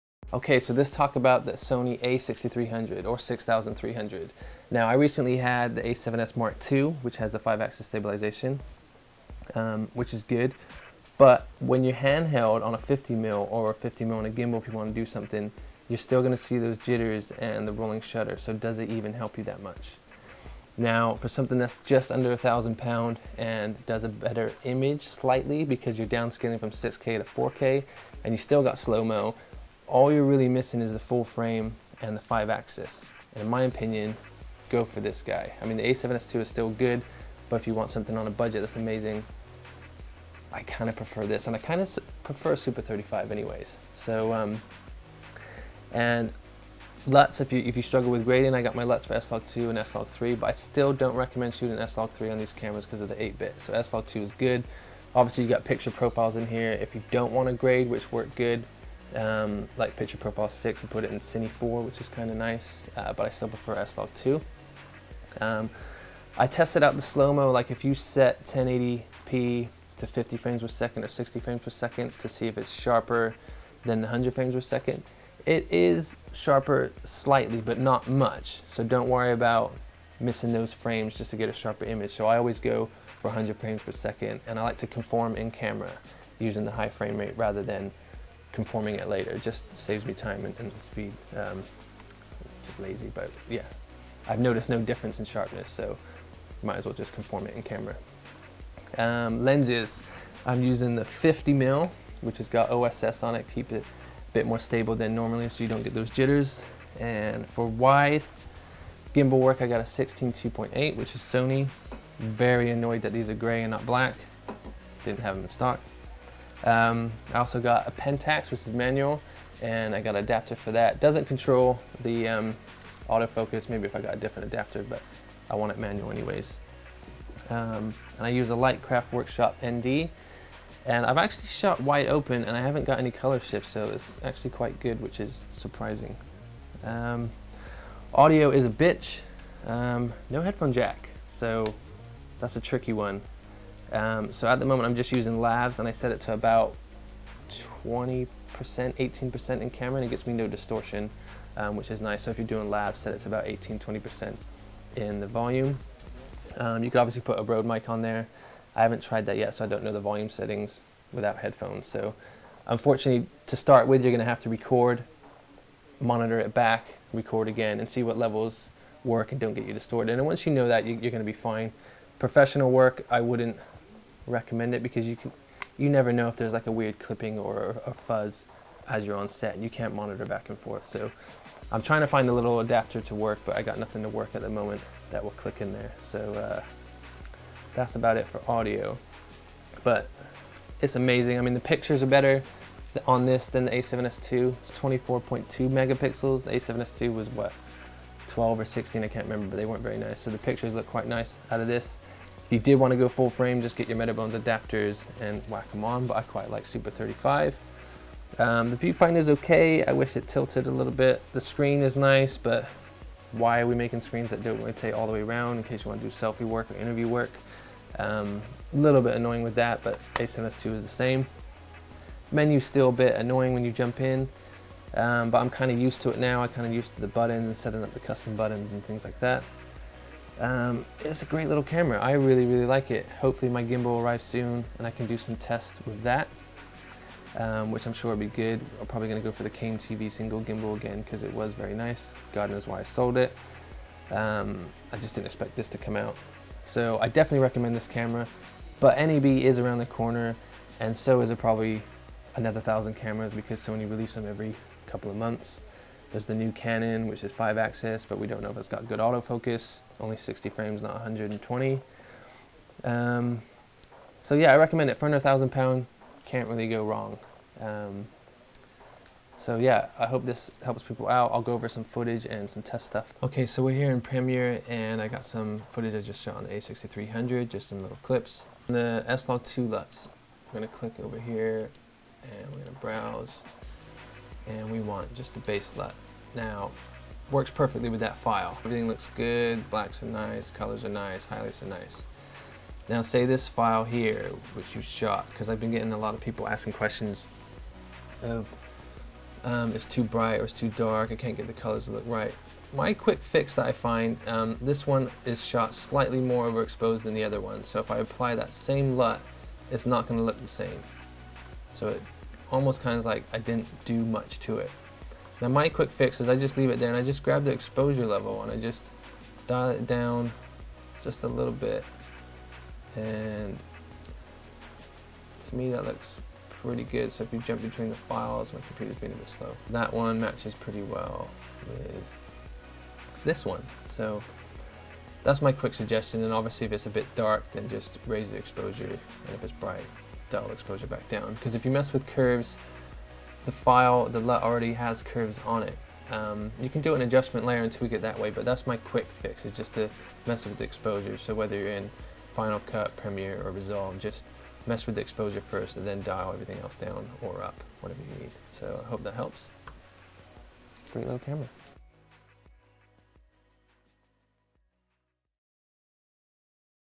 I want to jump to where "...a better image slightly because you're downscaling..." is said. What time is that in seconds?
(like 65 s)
24 s.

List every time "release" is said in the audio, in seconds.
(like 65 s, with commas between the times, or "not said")
253 s.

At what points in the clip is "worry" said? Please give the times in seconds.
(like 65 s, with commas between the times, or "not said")
79 s.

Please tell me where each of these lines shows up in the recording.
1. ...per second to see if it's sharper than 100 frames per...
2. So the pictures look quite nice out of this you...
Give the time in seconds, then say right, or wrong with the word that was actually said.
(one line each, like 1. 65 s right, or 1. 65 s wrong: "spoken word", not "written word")
1. 71 s right
2. 200 s right.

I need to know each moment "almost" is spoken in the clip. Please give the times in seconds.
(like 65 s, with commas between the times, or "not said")
312 s.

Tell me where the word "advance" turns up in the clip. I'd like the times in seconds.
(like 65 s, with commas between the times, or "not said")
not said.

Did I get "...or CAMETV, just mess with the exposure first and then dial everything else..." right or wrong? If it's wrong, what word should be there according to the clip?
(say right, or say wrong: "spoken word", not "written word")
wrong: "Resolve", not "CAMETV".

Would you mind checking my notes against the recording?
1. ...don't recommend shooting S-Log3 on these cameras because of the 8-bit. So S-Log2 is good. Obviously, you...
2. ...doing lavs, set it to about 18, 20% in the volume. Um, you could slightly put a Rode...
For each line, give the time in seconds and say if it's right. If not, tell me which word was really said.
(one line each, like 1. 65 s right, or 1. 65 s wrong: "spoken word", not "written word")
1. 50 s right
2. 152 s wrong: "obviously", not "slightly".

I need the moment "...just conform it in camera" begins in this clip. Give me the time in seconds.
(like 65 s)
96 s.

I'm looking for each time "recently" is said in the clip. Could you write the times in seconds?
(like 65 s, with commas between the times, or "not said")
4 s.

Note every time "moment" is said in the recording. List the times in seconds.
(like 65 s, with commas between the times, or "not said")
144 s, 184 s.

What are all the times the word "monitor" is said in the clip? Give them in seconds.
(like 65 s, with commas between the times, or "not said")
165 s, 179 s.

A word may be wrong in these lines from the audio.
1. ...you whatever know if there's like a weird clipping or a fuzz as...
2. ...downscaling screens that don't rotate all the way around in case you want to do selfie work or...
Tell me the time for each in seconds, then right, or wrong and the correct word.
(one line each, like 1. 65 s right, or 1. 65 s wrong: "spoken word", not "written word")
1. 175 s wrong: "never", not "whatever"
2. 213 s wrong: "making", not "downscaling".